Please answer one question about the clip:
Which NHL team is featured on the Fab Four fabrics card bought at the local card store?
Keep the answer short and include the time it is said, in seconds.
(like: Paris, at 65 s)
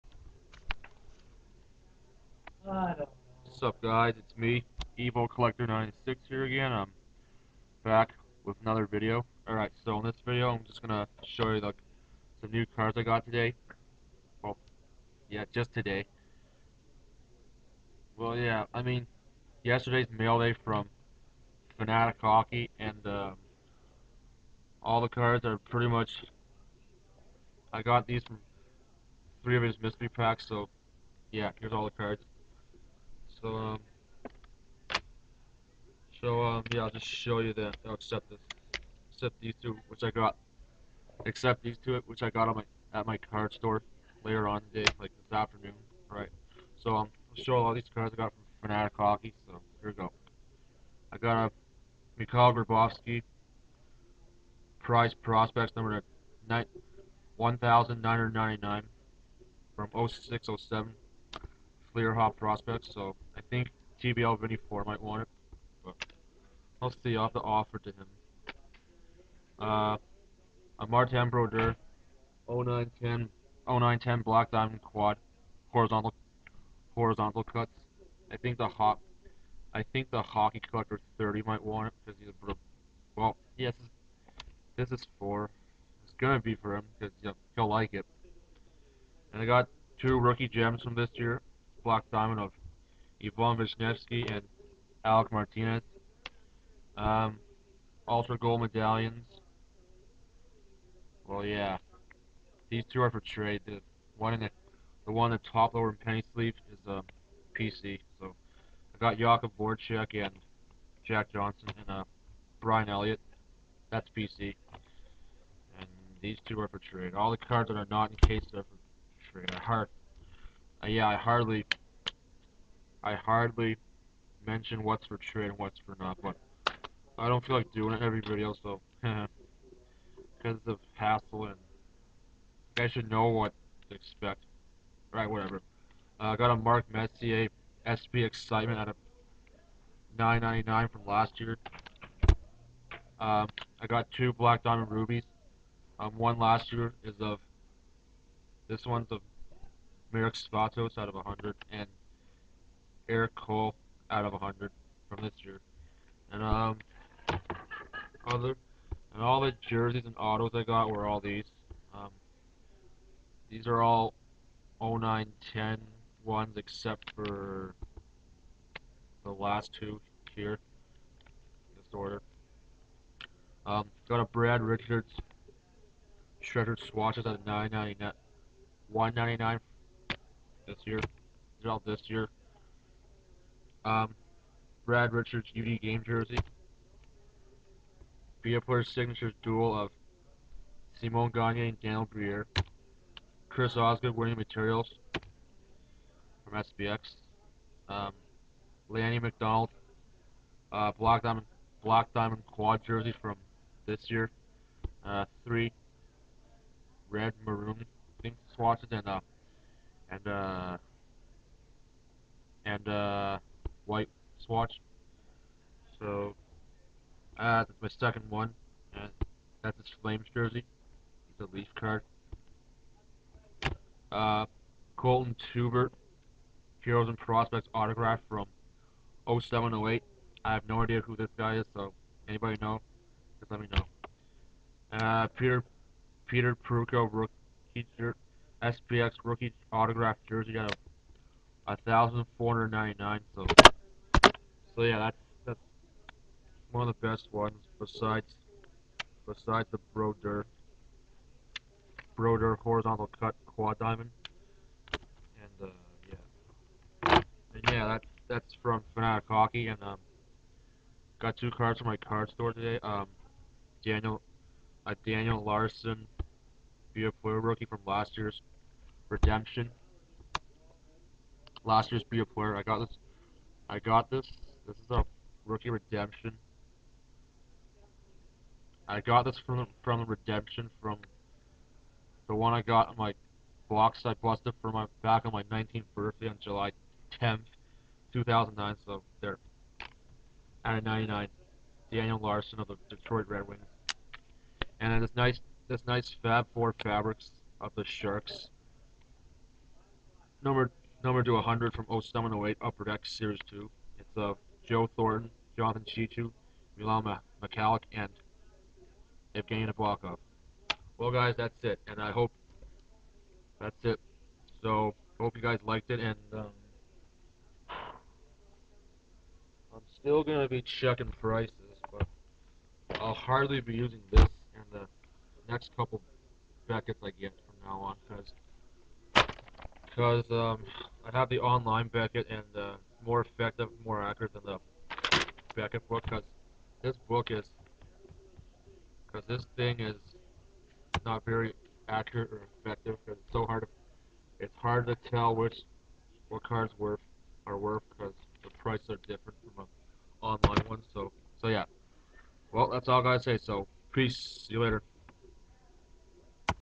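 Sharks, at 297 s.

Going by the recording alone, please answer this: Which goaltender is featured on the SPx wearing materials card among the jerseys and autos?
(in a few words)
Chris Osgood.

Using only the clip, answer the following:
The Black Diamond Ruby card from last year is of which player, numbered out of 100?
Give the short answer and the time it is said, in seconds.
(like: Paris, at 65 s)
Marek Svatos, at 150 s.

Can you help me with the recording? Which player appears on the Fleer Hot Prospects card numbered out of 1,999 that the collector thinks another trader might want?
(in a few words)
Mikhail Grabovski.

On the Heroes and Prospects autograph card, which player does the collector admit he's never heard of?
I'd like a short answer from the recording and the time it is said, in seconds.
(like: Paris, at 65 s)
Colton Teubert, at 224 s.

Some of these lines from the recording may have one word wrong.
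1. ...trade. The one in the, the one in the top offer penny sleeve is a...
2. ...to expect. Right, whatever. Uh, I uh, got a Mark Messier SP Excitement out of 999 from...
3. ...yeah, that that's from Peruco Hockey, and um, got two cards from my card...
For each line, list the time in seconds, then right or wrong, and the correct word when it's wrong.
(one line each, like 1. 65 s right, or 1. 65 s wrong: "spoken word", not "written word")
1. 103 s wrong: "lower", not "offer"
2. 133 s right
3. 257 s wrong: "Fanatic", not "Peruco".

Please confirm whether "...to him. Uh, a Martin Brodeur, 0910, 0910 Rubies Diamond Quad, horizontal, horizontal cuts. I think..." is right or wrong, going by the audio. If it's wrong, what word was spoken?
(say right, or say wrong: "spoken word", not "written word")
wrong: "Black", not "Rubies".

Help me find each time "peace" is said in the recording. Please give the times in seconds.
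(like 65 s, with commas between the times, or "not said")
353 s.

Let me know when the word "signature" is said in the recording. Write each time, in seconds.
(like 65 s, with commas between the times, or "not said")
188 s.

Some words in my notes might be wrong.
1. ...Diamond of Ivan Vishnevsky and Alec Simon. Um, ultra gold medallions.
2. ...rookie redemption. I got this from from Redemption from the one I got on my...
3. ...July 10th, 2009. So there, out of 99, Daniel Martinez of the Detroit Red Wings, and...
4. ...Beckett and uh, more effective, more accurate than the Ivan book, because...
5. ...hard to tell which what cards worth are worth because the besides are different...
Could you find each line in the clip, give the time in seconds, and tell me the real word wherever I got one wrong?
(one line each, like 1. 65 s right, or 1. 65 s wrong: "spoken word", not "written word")
1. 92 s wrong: "Martinez", not "Simon"
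2. 275 s right
3. 286 s wrong: "Larsson", not "Martinez"
4. 331 s wrong: "Beckett", not "Ivan"
5. 344 s wrong: "prices", not "besides".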